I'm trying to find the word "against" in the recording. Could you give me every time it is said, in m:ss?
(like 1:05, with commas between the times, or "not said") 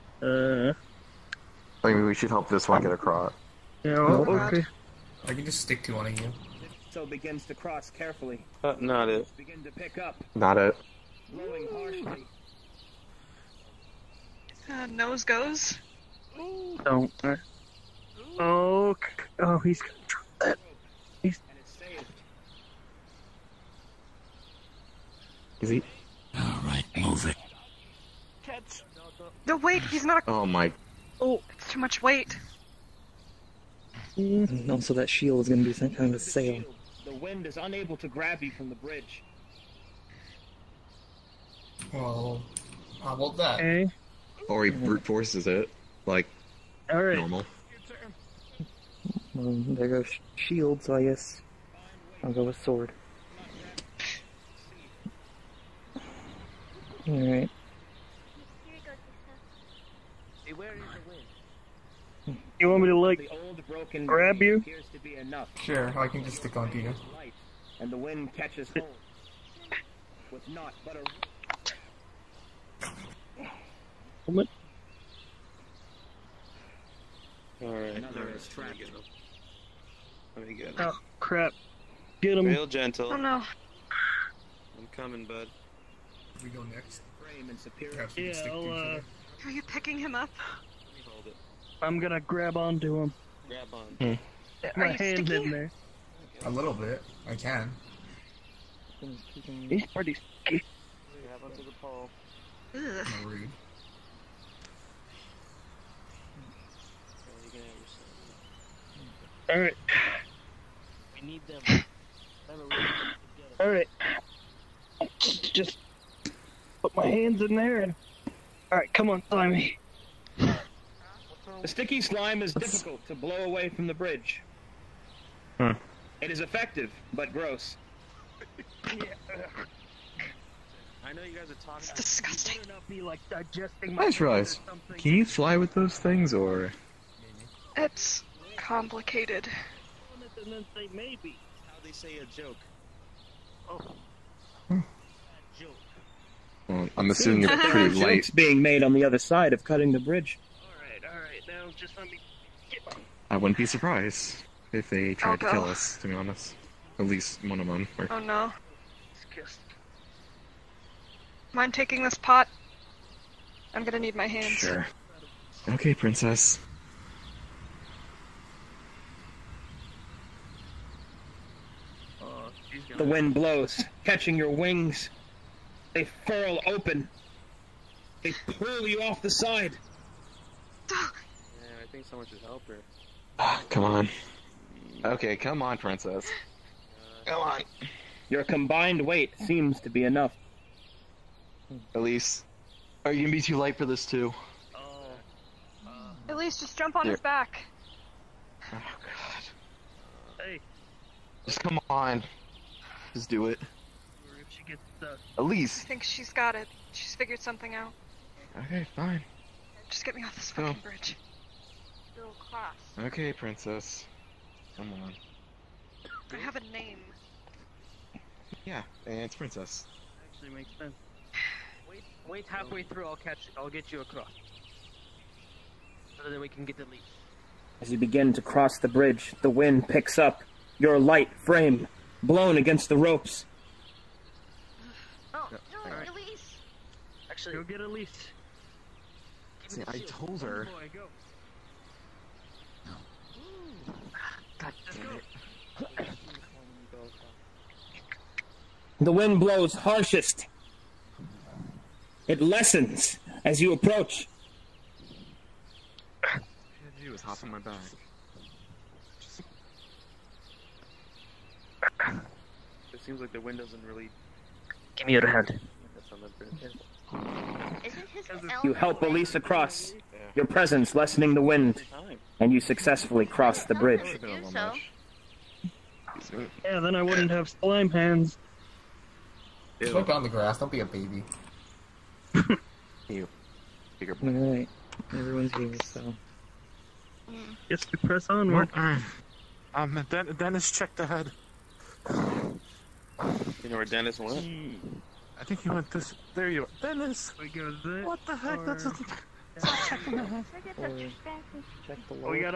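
3:52.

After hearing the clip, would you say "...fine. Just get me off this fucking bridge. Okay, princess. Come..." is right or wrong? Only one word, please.
right.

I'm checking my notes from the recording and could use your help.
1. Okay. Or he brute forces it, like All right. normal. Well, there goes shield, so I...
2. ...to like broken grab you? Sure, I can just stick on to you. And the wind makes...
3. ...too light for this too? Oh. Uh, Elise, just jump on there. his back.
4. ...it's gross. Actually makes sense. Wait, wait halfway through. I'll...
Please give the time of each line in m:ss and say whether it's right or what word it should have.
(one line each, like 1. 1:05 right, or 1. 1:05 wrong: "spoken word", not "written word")
1. 0:43 right
2. 1:02 wrong: "catches", not "makes"
3. 3:13 right
4. 3:39 wrong: "princess", not "gross".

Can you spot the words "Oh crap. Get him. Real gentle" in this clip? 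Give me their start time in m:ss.
1:20.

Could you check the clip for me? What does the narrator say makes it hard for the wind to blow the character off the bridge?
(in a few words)
Sticky slime.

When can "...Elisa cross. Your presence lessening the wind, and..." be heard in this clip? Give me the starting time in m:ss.
4:29.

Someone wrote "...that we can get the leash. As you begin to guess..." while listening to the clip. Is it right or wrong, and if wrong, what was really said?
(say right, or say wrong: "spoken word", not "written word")
wrong: "cross", not "guess".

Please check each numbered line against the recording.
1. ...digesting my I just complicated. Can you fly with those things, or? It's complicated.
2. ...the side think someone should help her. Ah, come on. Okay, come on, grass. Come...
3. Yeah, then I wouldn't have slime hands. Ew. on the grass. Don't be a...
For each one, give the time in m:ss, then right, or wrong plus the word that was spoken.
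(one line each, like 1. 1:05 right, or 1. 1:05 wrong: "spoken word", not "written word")
1. 2:13 wrong: "realized", not "complicated"
2. 2:59 wrong: "princess", not "grass"
3. 4:36 right.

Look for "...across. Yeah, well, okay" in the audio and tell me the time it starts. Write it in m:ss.
0:02.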